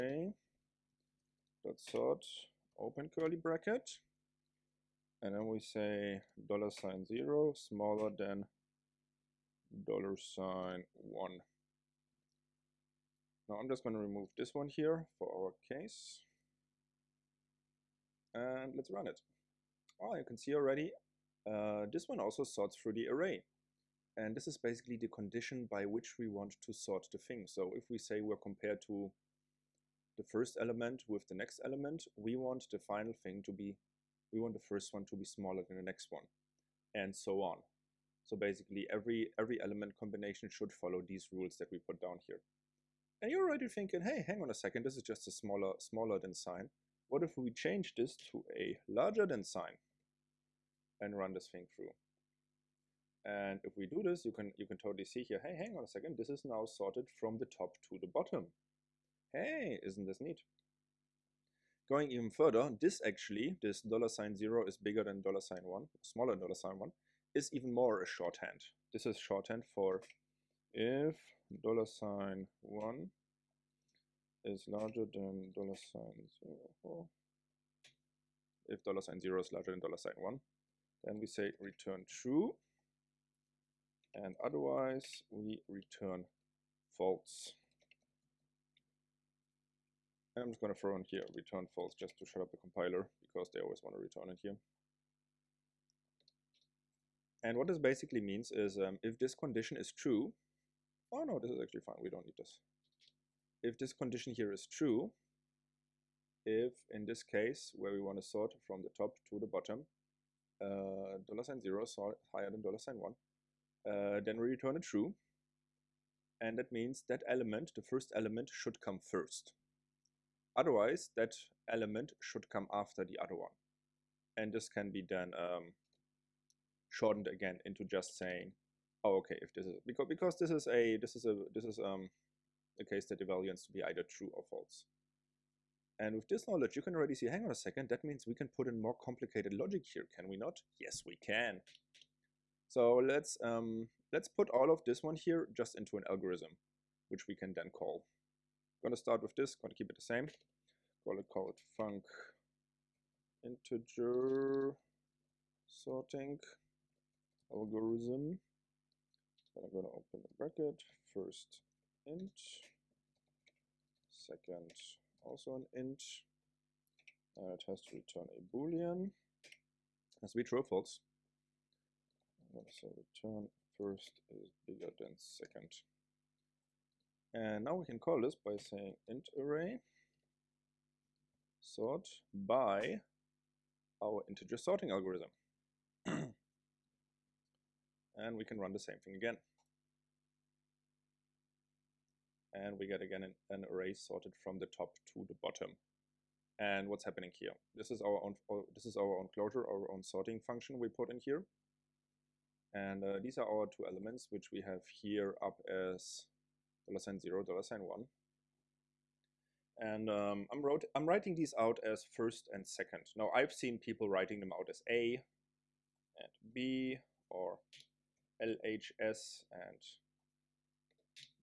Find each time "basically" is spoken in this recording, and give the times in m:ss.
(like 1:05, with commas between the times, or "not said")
0:24, 0:38, 1:37.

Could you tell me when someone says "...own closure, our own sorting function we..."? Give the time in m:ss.
3:19.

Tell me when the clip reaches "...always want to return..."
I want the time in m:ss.
1:33.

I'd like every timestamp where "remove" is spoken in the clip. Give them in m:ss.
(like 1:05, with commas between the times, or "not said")
0:14.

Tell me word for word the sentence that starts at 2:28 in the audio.
I'm gonna start with this, gonna keep it the same.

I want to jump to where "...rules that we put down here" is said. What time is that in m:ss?
0:41.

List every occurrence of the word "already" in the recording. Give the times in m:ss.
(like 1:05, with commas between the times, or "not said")
0:20, 0:43, 2:16.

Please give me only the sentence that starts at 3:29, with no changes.
And um, I'm, wrote, I'm writing these out as first and second.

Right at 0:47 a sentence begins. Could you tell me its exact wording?
What if we change this to a larger than sign and run this thing through?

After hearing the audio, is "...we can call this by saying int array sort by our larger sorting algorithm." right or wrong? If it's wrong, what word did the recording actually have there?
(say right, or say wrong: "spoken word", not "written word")
wrong: "integer", not "larger".